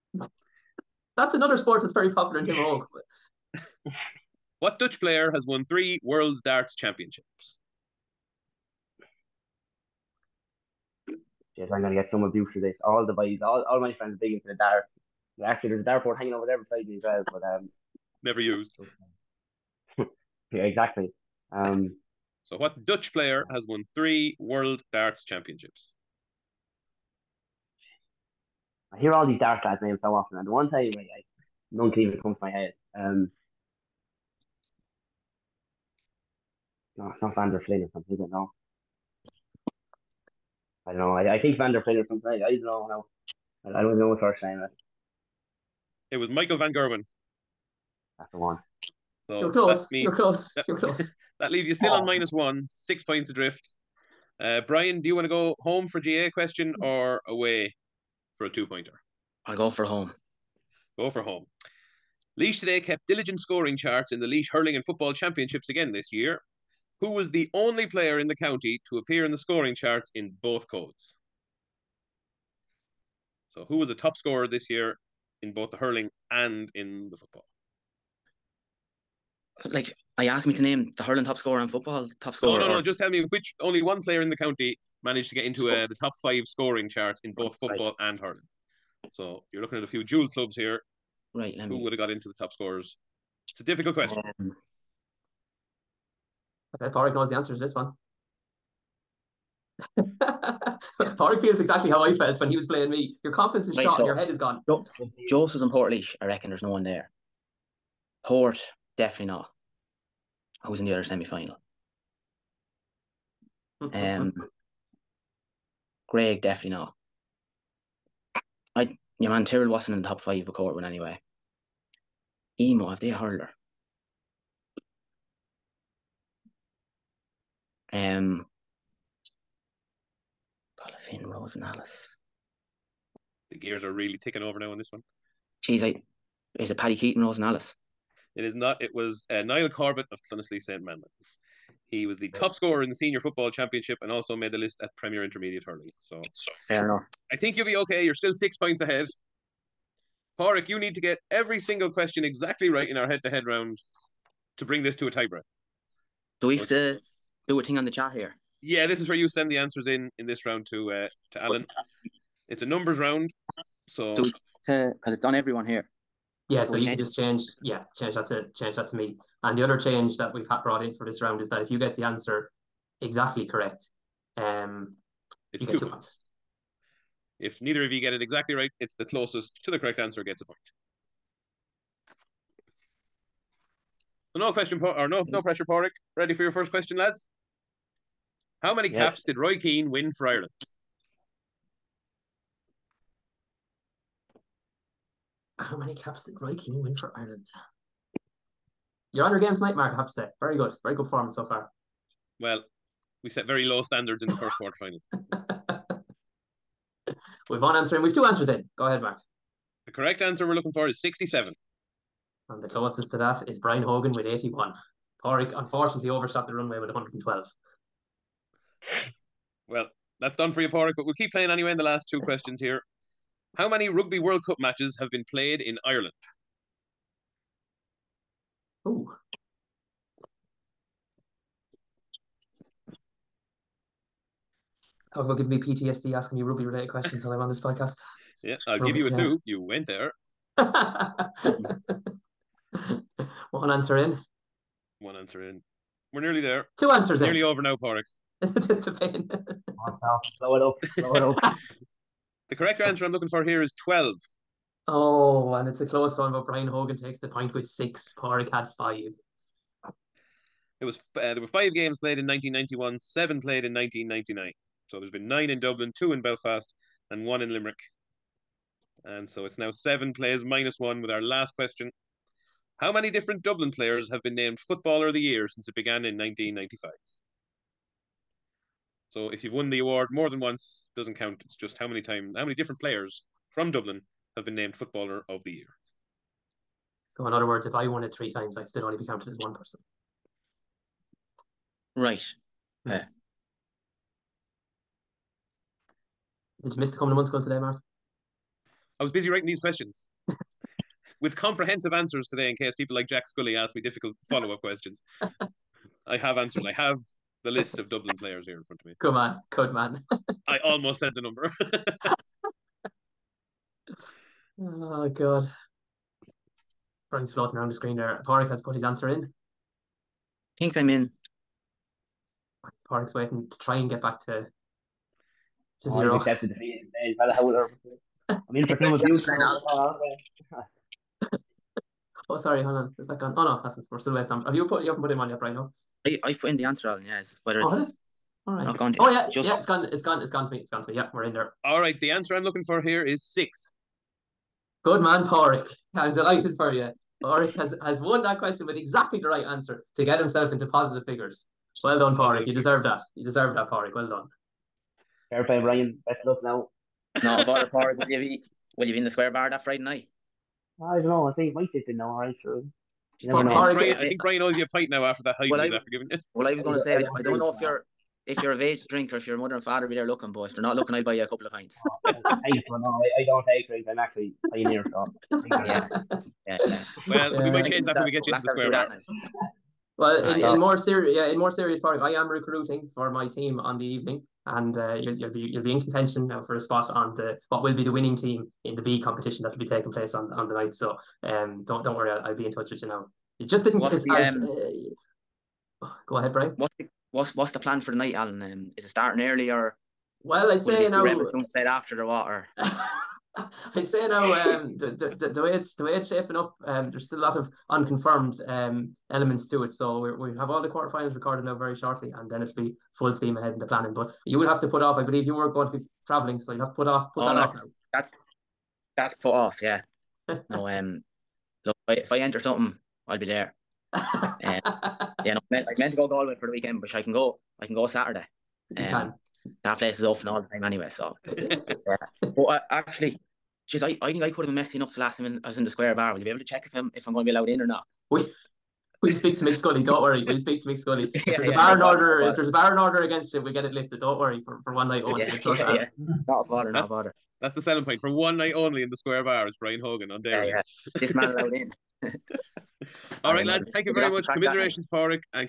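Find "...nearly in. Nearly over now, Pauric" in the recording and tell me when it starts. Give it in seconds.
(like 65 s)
247 s.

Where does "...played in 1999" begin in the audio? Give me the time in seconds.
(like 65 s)
263 s.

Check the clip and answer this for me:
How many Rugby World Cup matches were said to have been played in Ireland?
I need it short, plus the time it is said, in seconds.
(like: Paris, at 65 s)
12, at 253 s.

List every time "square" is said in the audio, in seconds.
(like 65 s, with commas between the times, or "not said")
359 s, 378 s, 435 s, 448 s.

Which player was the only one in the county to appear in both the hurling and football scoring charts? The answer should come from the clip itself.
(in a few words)
Niall Corbett.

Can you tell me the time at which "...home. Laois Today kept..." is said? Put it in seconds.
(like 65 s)
61 s.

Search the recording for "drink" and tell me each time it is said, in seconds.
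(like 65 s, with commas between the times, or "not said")
368 s, 373 s.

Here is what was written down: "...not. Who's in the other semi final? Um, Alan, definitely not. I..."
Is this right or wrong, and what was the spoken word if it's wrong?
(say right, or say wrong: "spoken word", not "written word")
wrong: "Greg", not "Alan".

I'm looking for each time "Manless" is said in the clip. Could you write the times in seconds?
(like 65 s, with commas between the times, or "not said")
140 s.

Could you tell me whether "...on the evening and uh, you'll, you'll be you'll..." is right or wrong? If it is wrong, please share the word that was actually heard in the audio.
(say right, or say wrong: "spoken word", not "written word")
right.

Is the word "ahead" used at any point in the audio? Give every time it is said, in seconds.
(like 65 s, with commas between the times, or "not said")
148 s, 208 s, 396 s, 413 s.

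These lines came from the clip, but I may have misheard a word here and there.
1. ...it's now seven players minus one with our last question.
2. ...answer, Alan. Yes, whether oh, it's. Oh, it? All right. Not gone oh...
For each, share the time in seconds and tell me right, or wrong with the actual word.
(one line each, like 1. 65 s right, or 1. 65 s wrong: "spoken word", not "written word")
1. 269 s right
2. 336 s right.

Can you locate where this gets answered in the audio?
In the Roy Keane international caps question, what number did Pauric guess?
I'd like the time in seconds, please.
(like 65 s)
216 s.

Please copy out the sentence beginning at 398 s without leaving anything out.
Um, is it starting early or?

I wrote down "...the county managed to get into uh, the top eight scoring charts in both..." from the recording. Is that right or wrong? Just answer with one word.
wrong.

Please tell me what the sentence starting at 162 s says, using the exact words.
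It's a numbers round, so do we to because it's on everyone here.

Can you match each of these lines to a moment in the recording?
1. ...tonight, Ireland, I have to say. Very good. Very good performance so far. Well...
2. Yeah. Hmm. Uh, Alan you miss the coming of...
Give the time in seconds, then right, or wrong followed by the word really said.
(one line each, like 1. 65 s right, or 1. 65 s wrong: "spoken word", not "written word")
1. 199 s wrong: "Mark", not "Ireland"
2. 292 s wrong: "Did", not "Alan".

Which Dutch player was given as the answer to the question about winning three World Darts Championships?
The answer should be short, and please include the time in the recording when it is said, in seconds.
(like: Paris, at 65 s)
Michael Van Gerwen, at 46 s.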